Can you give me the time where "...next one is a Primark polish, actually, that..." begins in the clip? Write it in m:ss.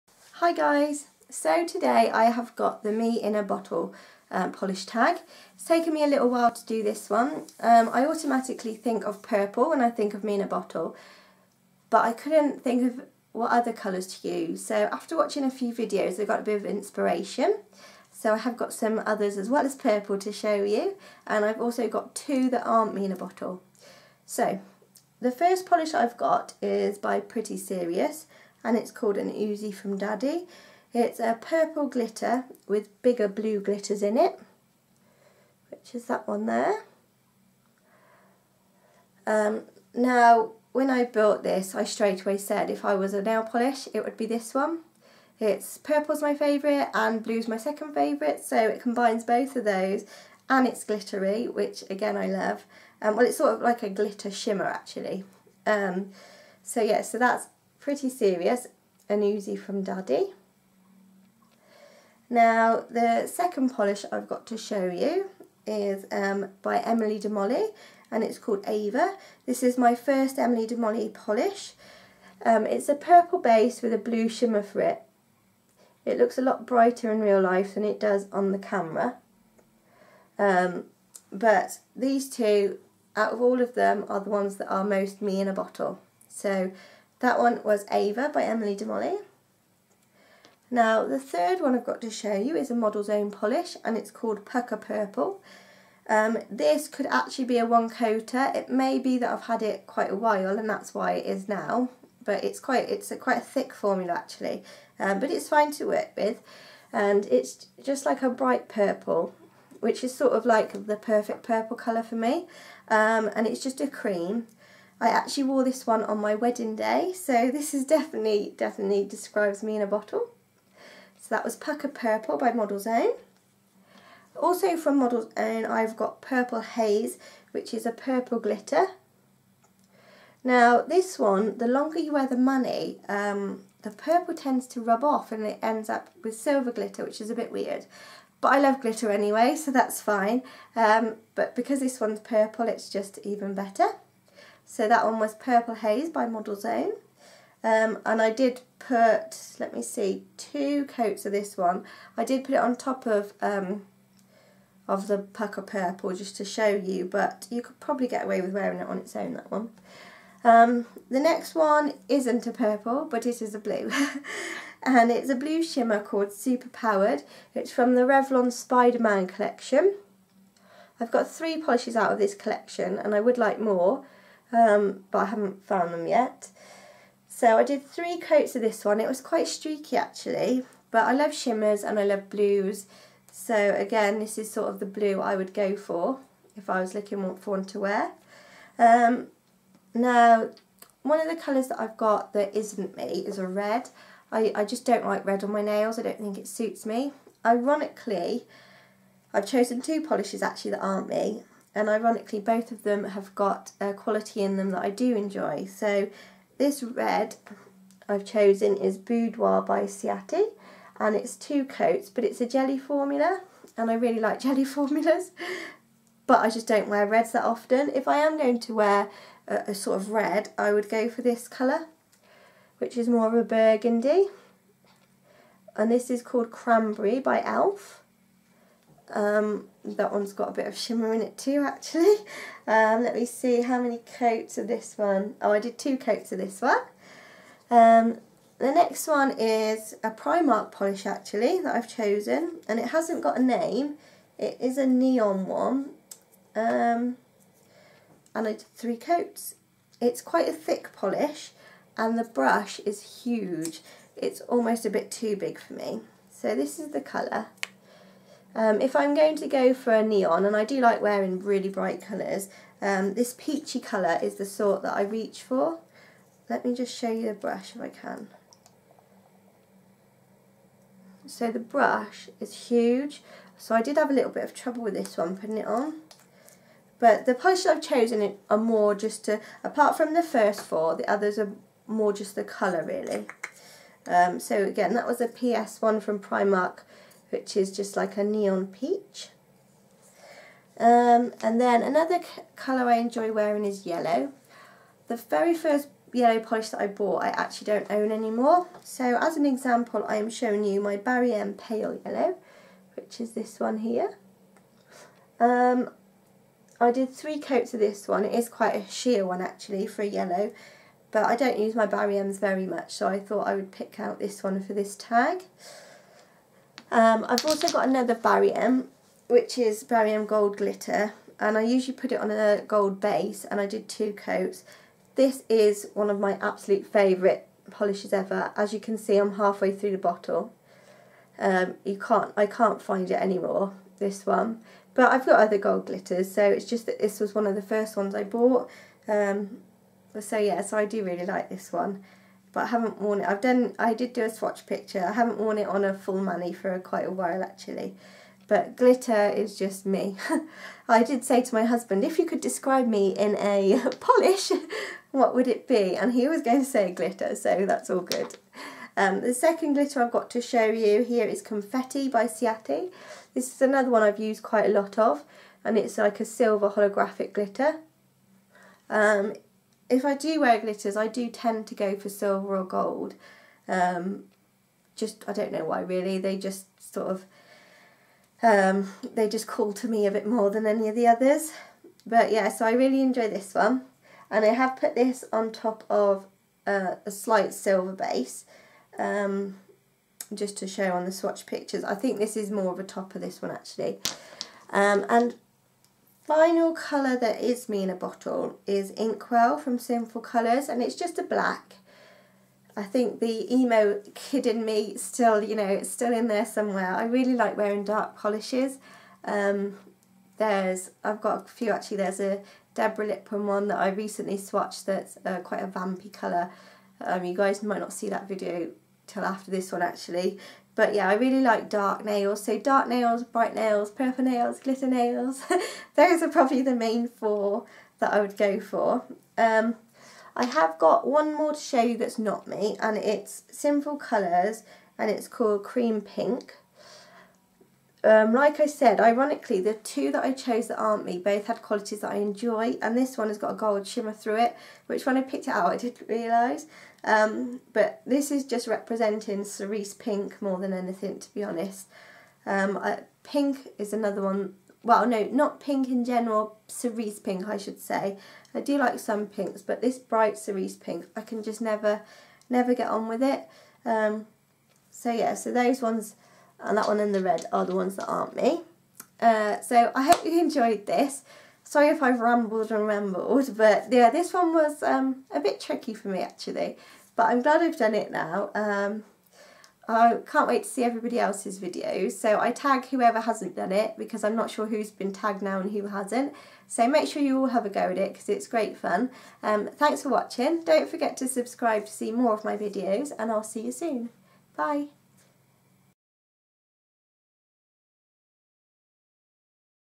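3:58.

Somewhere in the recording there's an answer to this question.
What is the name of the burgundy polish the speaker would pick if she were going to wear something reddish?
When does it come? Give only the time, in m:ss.
3:46.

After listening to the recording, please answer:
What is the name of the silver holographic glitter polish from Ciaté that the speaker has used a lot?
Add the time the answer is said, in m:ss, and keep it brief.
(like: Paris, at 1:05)
Confetti, at 6:01.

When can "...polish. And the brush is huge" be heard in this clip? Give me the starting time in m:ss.
4:10.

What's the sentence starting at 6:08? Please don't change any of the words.
Um, if I do wear glitters, I do tend to go for silver or gold.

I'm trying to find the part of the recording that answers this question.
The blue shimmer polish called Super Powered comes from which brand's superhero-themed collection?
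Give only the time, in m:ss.
2:48.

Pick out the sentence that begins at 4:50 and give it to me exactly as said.
Um, and then another colour I enjoy wearing is yellow.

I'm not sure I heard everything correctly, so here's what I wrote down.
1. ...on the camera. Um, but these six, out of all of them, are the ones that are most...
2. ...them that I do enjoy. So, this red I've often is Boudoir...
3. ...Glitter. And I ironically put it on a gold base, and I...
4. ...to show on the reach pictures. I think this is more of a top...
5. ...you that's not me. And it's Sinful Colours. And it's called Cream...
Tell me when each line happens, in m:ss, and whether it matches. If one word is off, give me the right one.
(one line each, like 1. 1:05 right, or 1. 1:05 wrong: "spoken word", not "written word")
1. 1:18 wrong: "two", not "six"
2. 3:24 wrong: "chosen", not "often"
3. 5:20 wrong: "usually", not "ironically"
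4. 6:30 wrong: "swatch", not "reach"
5. 7:11 right.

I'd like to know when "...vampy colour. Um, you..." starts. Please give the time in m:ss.
6:55.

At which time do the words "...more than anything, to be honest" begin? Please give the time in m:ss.
7:30.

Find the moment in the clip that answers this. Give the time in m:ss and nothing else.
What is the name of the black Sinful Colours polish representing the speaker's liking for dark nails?
6:38.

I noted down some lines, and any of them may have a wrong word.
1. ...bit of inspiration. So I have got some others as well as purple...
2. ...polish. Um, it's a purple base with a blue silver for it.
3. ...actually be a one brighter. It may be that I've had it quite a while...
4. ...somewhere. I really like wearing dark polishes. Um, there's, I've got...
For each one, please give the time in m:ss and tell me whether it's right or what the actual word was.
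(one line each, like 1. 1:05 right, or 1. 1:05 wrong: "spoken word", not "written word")
1. 0:16 right
2. 1:11 wrong: "shimmer", not "silver"
3. 1:37 wrong: "coater", not "brighter"
4. 6:46 right.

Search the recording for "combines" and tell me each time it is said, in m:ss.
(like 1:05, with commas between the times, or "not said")
0:48.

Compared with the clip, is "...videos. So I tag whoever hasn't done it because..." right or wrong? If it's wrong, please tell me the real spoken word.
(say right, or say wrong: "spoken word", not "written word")
right.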